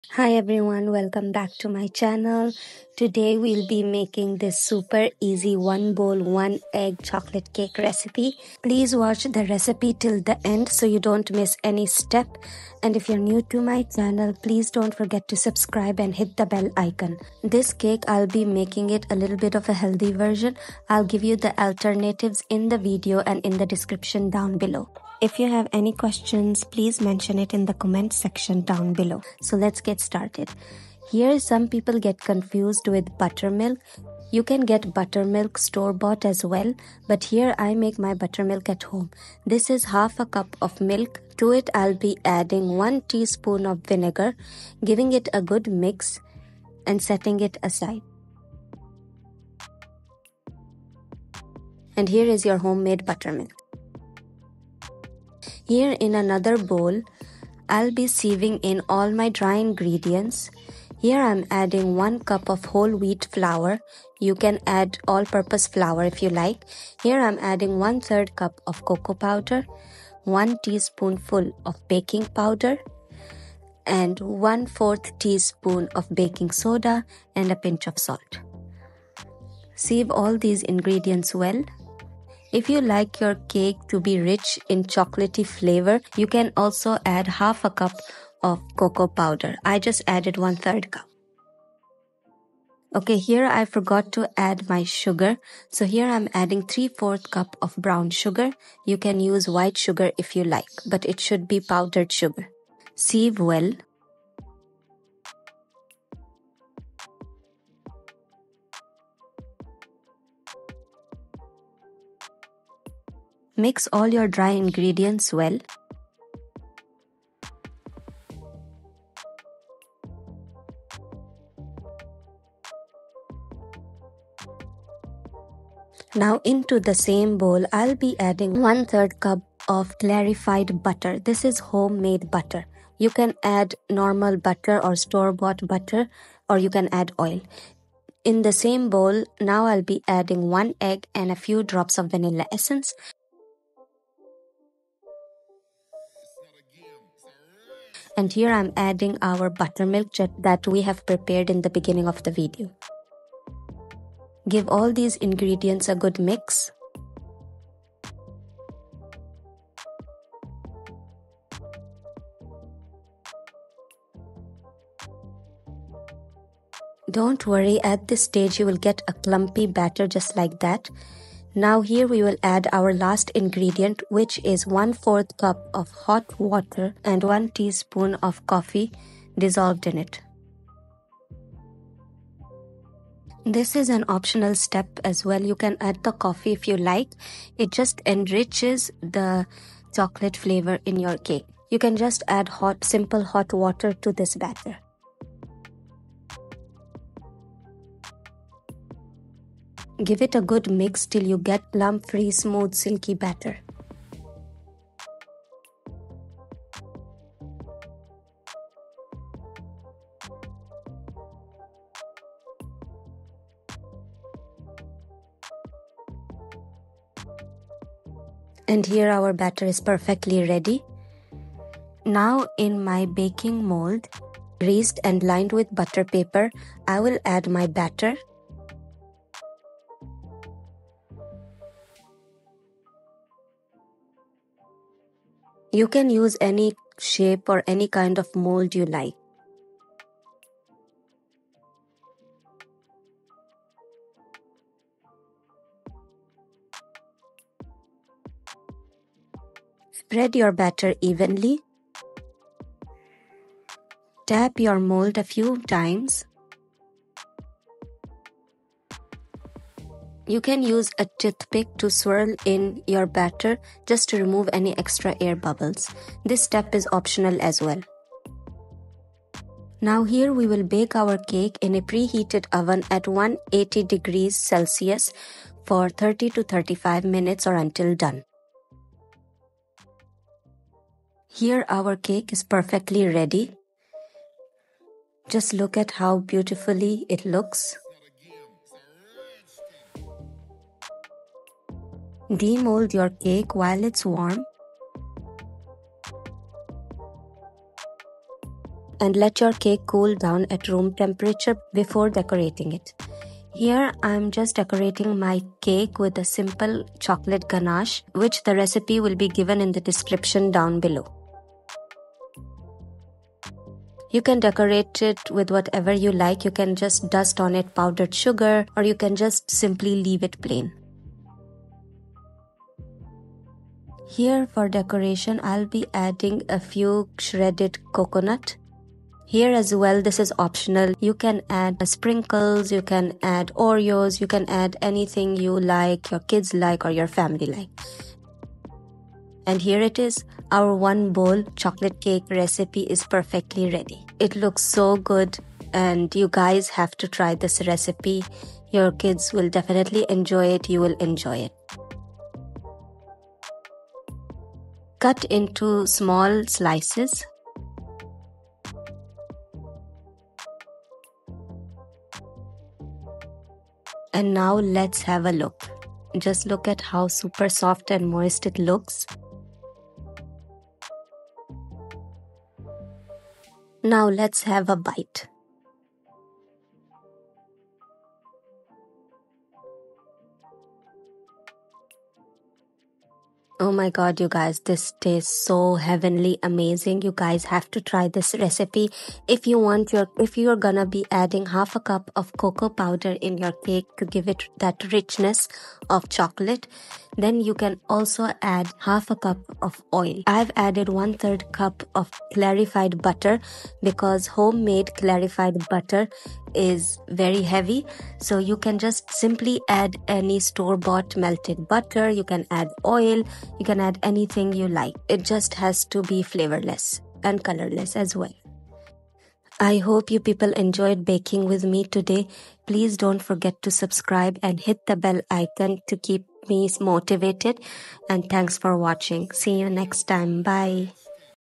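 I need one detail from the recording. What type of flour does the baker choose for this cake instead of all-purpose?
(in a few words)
whole wheat flour.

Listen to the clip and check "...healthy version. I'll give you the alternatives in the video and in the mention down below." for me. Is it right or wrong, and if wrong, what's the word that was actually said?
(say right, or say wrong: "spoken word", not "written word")
wrong: "description", not "mention".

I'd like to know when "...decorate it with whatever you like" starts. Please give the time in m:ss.
5:14.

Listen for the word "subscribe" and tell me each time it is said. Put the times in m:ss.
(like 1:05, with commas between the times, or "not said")
0:15, 7:03.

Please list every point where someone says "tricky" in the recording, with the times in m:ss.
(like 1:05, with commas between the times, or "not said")
not said.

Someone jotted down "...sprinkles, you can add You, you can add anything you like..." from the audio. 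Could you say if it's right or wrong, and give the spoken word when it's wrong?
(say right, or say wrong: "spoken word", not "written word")
wrong: "Oreos", not "You".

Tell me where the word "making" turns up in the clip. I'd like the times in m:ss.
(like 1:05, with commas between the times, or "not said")
0:03, 0:18.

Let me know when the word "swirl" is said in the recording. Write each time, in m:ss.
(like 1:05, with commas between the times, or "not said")
4:21.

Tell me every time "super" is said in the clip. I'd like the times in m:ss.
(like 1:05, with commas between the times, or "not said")
0:04, 6:07.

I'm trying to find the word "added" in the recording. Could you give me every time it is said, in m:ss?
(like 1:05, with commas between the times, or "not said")
1:30, 6:40.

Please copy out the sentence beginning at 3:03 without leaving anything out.
This is an optional step as well.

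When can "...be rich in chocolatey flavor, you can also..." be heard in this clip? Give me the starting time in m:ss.
1:24.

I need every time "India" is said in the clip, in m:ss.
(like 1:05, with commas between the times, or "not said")
not said.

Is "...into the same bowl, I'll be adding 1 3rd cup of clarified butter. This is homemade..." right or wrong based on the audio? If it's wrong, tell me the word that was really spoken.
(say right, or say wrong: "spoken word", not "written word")
right.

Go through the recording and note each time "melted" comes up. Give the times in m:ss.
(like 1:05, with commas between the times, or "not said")
6:51.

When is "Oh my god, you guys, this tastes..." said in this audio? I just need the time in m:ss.
6:23.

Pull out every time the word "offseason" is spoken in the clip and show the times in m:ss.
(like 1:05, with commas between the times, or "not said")
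not said.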